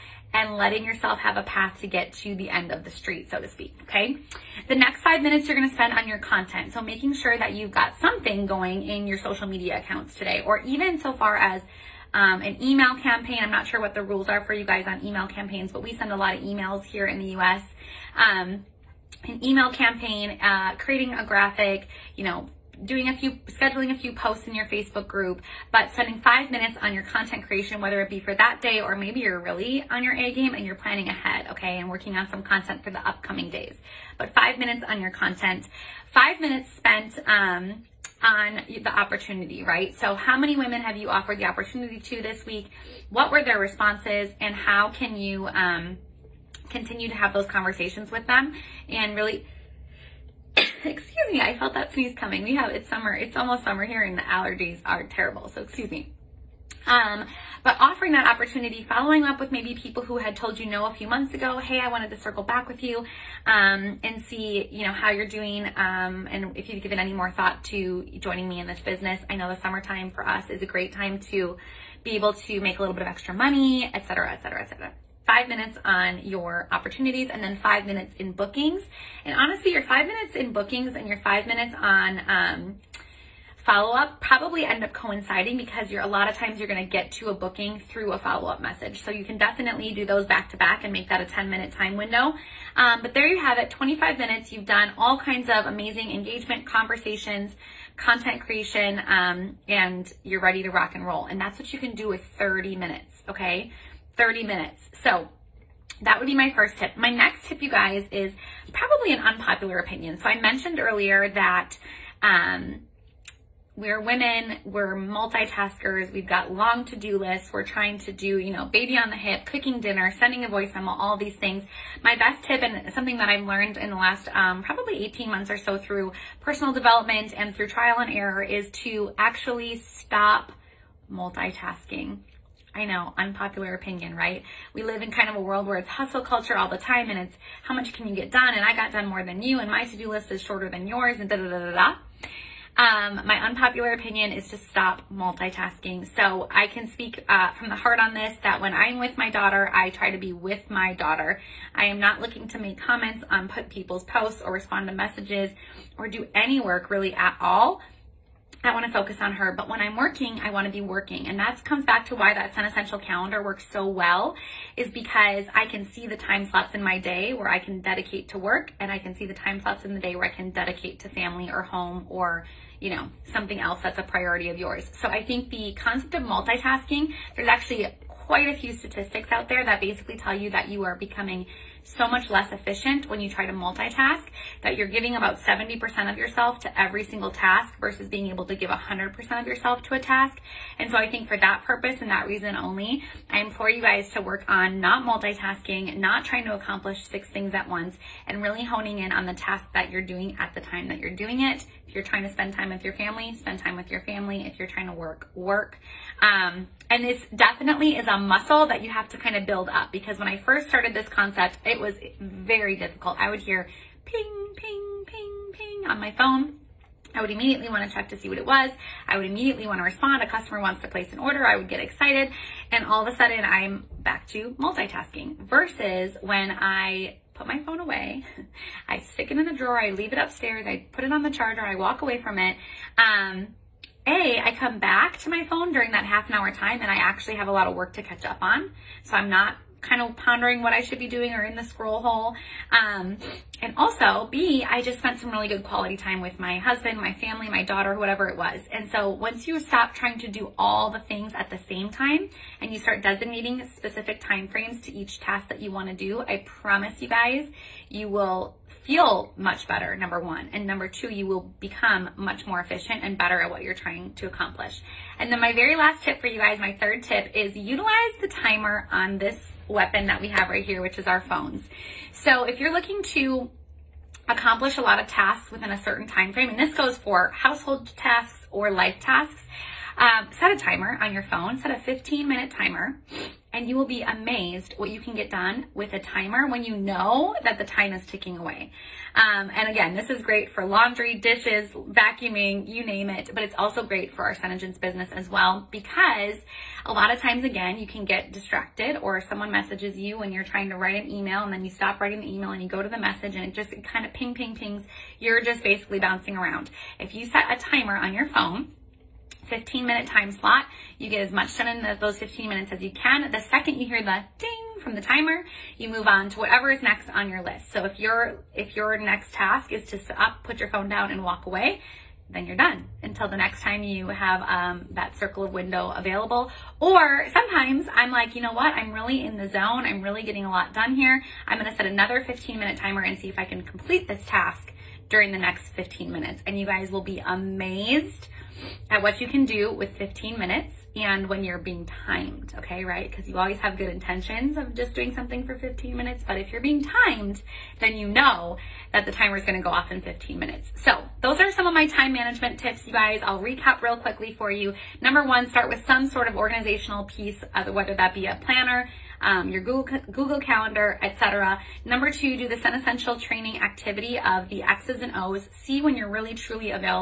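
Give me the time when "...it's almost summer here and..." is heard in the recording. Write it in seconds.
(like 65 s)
53 s.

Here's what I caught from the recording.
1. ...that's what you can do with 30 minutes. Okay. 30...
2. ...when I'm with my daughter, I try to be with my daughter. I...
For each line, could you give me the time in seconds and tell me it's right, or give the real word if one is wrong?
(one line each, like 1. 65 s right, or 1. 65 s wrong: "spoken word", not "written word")
1. 101 s right
2. 148 s right.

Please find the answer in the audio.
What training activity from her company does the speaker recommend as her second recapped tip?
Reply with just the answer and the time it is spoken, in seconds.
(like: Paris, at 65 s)
X's and O's, at 364 s.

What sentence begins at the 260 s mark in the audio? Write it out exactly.
And number two, you will become much more efficient and better at what you're trying to accomplish.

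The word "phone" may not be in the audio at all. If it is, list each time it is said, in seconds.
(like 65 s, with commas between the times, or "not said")
216 s, 227 s, 235 s, 271 s, 281 s, 308 s, 320 s.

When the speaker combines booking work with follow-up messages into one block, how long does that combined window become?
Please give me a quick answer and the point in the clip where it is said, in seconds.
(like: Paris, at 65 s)
10 minutes, at 91 s.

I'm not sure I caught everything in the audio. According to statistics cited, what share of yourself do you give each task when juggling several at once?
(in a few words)
70%.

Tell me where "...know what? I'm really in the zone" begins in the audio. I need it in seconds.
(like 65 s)
328 s.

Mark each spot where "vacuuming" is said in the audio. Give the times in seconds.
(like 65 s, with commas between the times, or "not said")
291 s.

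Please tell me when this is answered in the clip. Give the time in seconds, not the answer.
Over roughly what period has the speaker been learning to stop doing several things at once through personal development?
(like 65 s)
125 s.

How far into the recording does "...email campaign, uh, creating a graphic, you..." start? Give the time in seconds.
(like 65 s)
19 s.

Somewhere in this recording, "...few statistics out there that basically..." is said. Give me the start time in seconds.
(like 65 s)
178 s.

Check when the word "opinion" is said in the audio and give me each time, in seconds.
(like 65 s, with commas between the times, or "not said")
109 s, 133 s, 143 s.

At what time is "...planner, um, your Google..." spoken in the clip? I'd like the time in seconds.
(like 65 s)
358 s.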